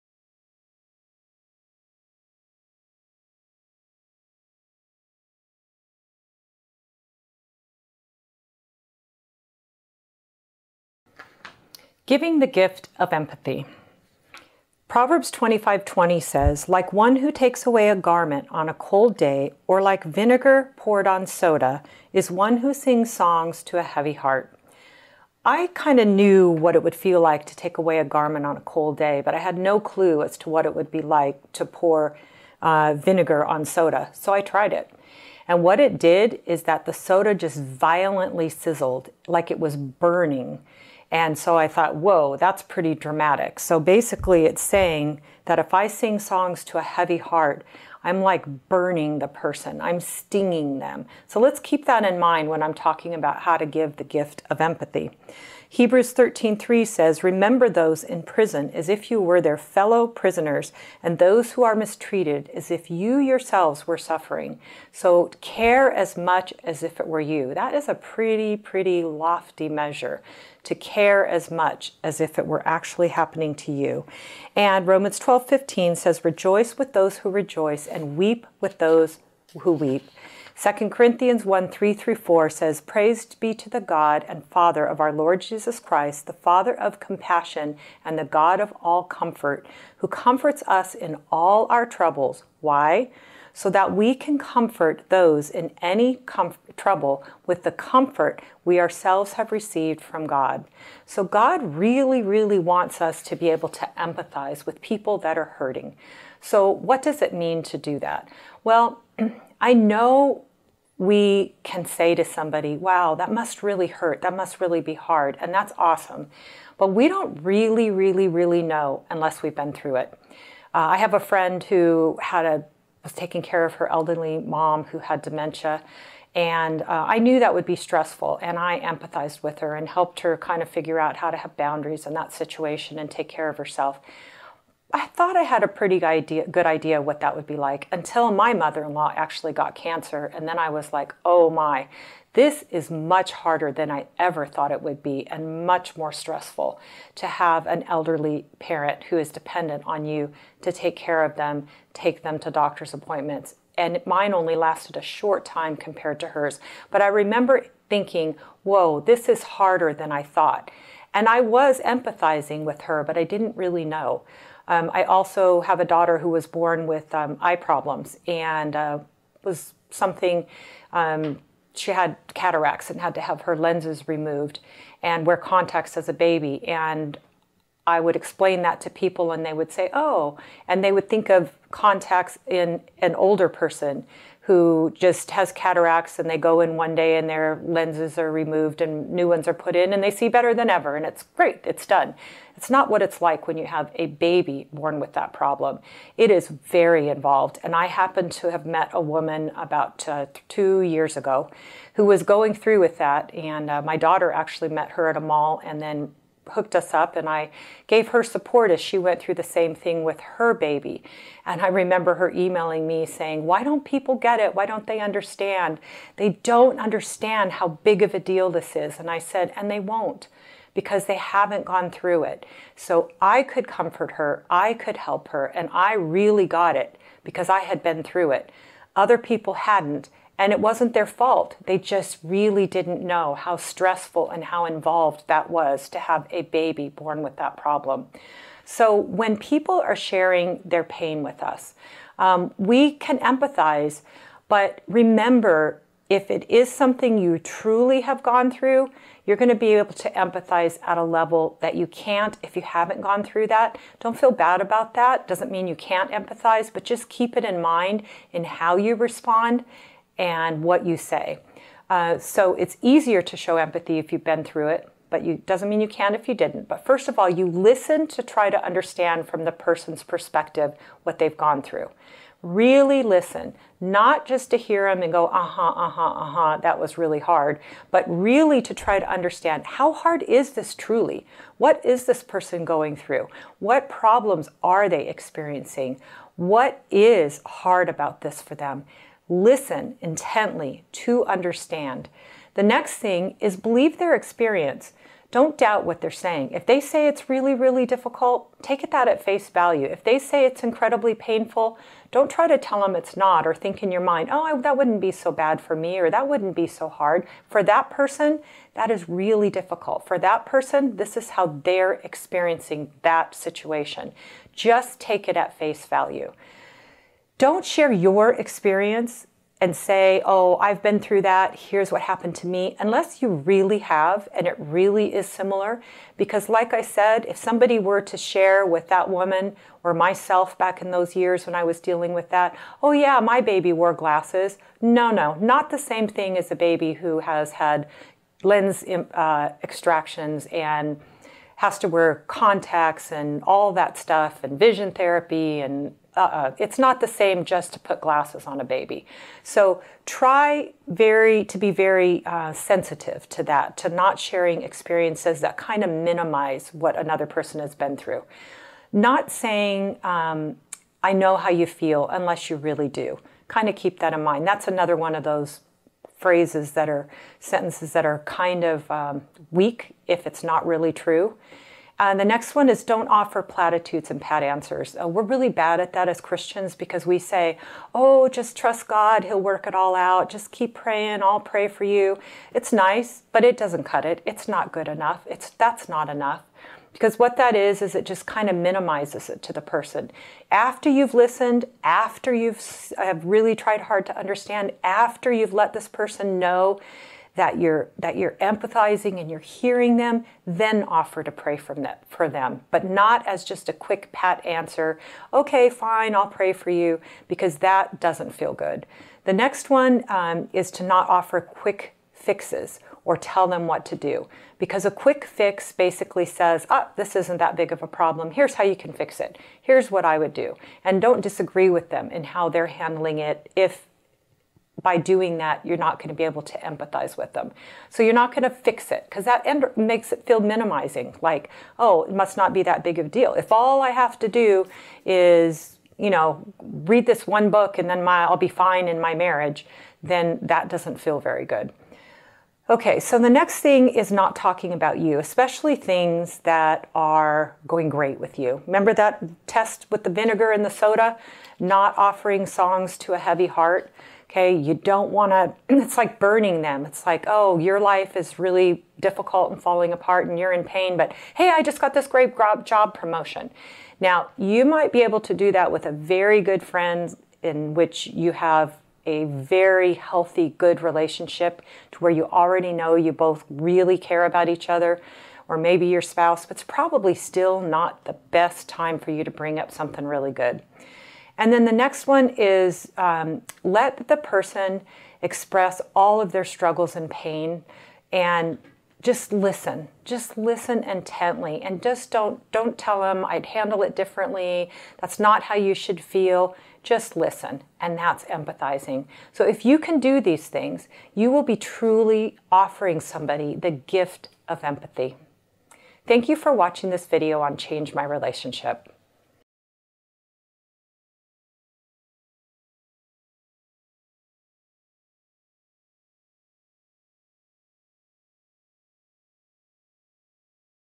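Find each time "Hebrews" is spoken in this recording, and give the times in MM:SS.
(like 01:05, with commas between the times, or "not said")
00:55.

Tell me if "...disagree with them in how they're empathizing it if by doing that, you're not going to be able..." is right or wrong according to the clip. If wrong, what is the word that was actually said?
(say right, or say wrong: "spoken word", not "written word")
wrong: "handling", not "empathizing".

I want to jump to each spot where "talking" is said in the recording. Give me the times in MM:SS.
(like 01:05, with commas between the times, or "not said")
00:52, 07:24.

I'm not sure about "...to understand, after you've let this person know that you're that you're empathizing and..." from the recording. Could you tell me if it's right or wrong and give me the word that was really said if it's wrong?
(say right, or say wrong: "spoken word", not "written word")
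right.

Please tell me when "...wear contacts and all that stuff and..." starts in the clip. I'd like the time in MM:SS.
05:41.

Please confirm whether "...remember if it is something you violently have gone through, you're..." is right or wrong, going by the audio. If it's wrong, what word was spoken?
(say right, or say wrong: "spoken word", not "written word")
wrong: "truly", not "violently".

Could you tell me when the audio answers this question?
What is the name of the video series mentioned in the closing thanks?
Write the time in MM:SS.
08:27.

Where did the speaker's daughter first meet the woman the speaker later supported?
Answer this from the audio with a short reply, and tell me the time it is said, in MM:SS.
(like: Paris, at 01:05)
A mall, at 03:25.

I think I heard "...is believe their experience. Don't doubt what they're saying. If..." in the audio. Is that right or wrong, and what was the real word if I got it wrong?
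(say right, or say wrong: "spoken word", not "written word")
right.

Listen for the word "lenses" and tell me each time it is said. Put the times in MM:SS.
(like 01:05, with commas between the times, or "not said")
02:53, 03:07.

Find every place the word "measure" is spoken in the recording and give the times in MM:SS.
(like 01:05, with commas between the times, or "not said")
01:09.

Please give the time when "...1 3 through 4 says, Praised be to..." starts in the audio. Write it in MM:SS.
01:21.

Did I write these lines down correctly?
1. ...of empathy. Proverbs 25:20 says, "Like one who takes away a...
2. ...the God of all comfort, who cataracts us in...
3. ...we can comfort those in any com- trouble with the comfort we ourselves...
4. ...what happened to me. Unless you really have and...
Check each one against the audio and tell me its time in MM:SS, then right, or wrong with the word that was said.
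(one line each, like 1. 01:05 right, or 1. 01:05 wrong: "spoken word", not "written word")
1. 00:12 right
2. 01:28 wrong: "comforts", not "cataracts"
3. 01:33 right
4. 05:21 right.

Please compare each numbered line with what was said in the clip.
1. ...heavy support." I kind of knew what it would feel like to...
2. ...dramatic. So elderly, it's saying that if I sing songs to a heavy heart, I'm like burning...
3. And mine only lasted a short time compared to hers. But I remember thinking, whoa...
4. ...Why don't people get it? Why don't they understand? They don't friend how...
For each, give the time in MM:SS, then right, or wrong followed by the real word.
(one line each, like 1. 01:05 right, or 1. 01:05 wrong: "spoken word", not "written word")
1. 00:23 wrong: "heart", not "support"
2. 00:42 wrong: "basically", not "elderly"
3. 02:33 right
4. 03:33 wrong: "understand", not "friend".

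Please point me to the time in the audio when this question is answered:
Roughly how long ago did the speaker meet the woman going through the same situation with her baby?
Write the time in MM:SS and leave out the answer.
03:20.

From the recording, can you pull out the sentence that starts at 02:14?
I thought I had a pretty idea, good idea what that would be like until my mother in law actually got cancer.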